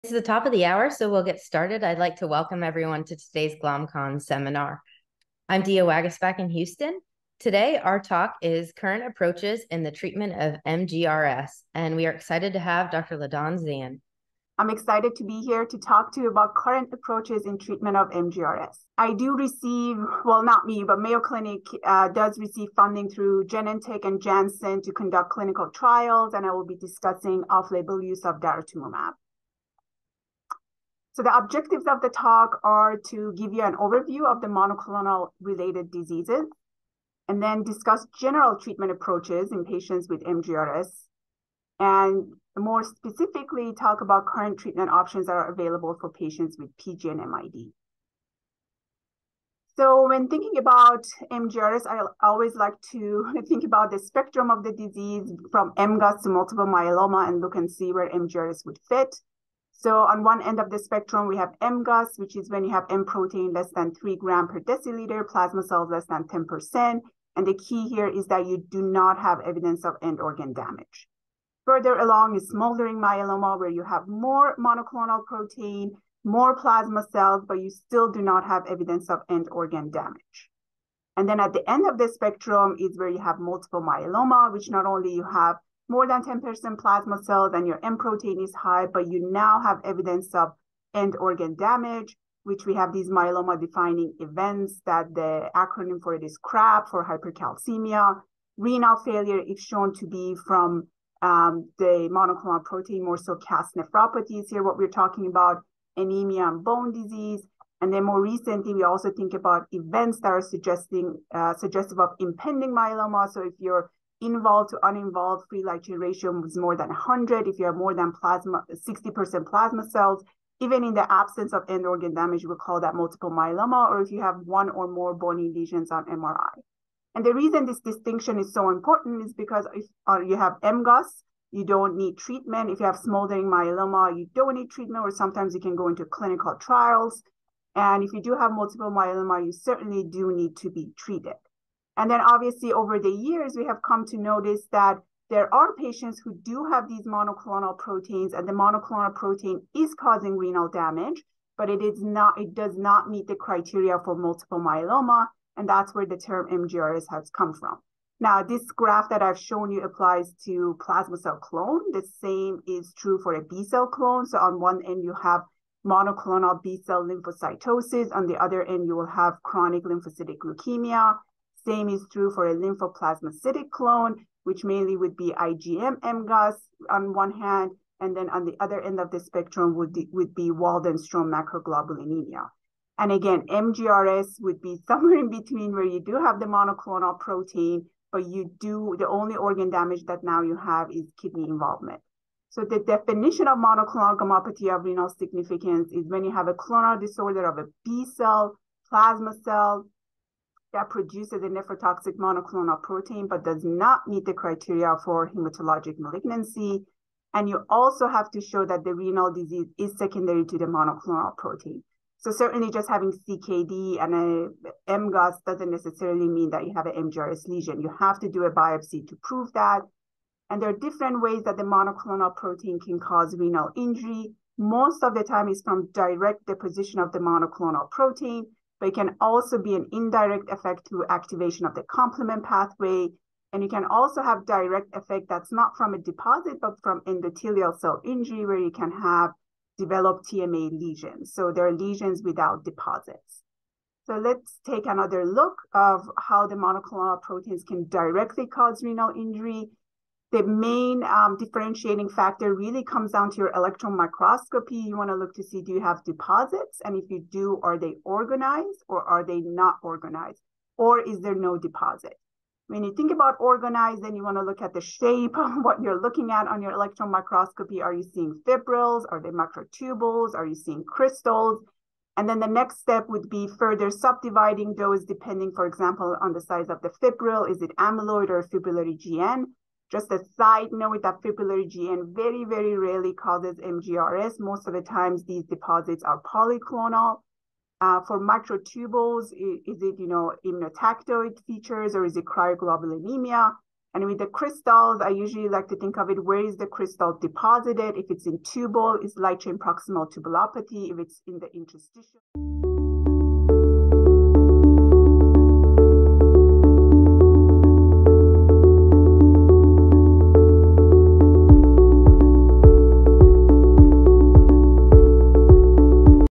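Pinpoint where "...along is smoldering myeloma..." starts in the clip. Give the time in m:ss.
1:11.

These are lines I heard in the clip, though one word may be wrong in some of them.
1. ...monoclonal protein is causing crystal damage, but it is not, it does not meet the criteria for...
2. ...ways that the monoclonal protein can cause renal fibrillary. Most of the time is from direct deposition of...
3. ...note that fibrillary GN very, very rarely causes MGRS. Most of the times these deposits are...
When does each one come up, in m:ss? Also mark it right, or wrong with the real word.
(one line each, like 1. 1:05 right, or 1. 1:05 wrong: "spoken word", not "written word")
1. 2:28 wrong: "renal", not "crystal"
2. 3:41 wrong: "injury", not "fibrillary"
3. 4:40 right.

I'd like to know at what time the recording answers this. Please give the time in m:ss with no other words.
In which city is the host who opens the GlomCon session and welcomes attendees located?
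0:06.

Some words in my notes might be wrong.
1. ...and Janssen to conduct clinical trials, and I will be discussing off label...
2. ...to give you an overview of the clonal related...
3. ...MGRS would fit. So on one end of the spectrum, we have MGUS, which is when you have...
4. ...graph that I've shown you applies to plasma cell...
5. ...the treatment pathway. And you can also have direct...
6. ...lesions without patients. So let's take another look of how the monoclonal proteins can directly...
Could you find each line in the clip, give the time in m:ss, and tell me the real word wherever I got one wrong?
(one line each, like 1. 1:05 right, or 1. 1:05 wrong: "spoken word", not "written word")
1. 0:24 right
2. 0:33 wrong: "monoclonal", not "clonal"
3. 0:58 right
4. 2:38 right
5. 3:51 wrong: "complement", not "treatment"
6. 4:01 wrong: "deposits", not "patients".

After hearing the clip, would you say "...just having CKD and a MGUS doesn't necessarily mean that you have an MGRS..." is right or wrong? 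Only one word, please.
right.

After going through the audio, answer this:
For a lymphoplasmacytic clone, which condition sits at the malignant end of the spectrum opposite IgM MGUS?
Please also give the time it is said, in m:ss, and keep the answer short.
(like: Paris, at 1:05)
Waldenstrom macroglobulinemia, at 3:00.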